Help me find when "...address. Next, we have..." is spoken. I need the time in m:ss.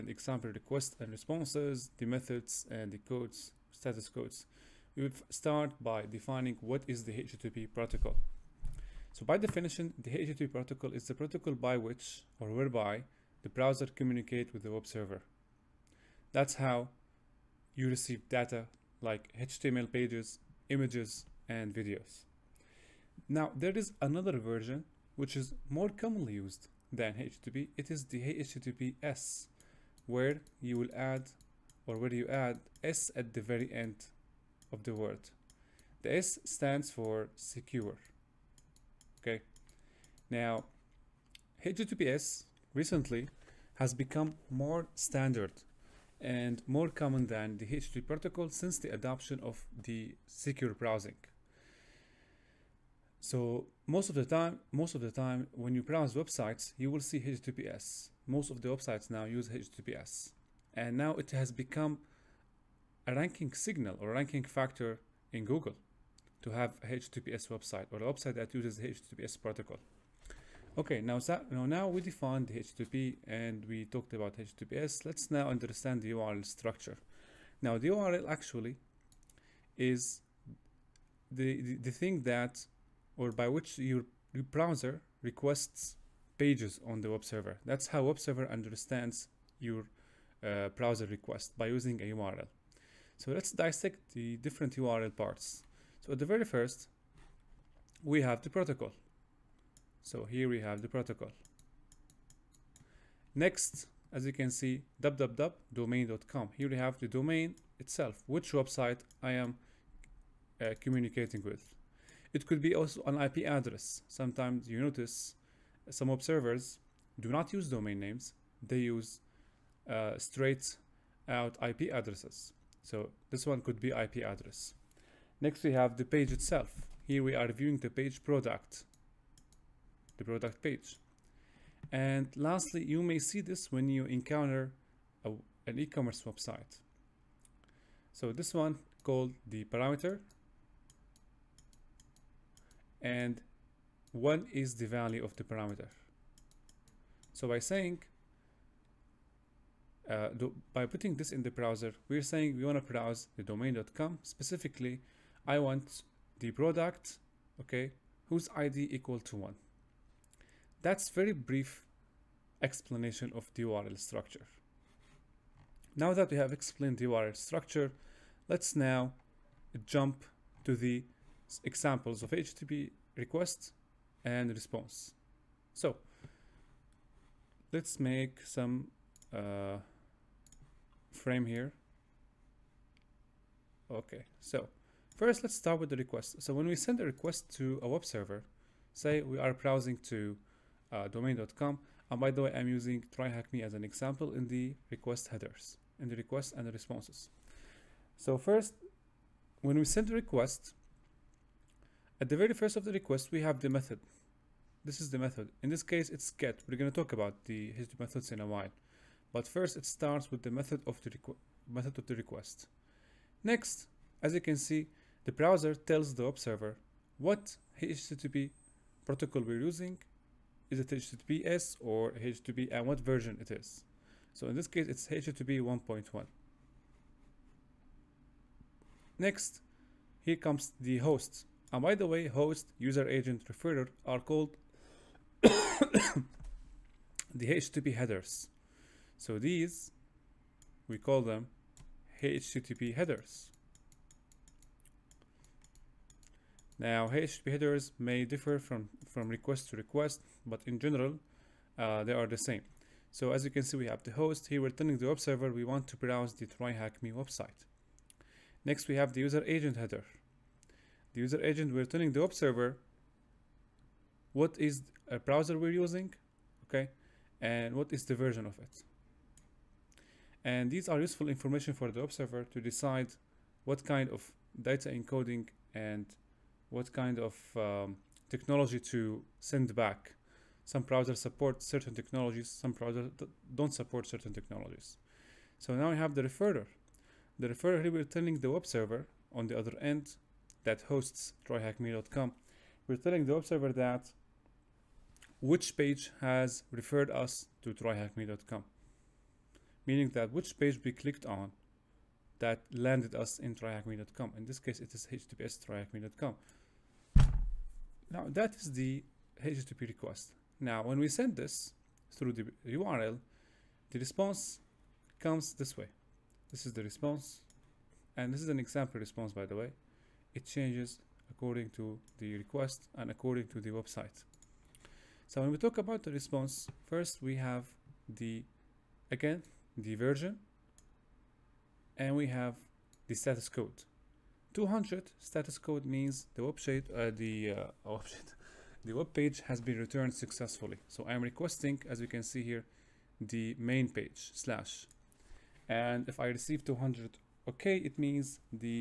2:04.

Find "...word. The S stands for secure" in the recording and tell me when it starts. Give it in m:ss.
0:34.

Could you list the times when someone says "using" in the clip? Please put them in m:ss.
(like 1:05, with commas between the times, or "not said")
1:31, 3:12, 3:39, 4:25.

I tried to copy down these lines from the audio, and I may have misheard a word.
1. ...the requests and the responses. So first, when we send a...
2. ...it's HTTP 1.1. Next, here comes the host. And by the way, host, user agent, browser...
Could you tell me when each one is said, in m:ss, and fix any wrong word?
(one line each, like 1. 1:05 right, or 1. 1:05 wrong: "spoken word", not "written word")
1. 3:16 right
2. 3:44 wrong: "referrer", not "browser".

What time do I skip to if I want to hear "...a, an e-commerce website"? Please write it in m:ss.
2:15.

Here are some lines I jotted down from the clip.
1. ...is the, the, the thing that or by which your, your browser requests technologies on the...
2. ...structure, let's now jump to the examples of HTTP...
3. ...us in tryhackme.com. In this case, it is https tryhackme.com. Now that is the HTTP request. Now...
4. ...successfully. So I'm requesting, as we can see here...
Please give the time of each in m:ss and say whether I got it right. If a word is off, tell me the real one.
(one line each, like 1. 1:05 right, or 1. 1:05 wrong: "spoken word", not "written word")
1. 1:19 wrong: "pages", not "technologies"
2. 2:47 right
3. 5:03 right
4. 5:40 right.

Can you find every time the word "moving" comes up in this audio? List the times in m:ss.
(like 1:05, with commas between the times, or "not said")
not said.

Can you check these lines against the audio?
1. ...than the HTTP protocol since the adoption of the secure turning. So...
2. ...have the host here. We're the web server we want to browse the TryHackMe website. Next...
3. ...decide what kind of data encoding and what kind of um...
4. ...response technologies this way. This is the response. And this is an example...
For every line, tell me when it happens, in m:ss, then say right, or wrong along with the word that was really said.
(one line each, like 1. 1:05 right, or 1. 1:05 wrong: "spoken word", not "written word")
1. 0:47 wrong: "browsing", not "turning"
2. 4:13 right
3. 4:32 right
4. 5:13 wrong: "comes", not "technologies".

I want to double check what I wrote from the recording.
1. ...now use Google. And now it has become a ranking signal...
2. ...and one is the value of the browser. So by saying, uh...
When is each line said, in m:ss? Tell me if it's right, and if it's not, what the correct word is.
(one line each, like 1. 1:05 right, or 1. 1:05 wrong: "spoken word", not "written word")
1. 0:59 wrong: "HTTPS", not "Google"
2. 2:23 wrong: "parameter", not "browser".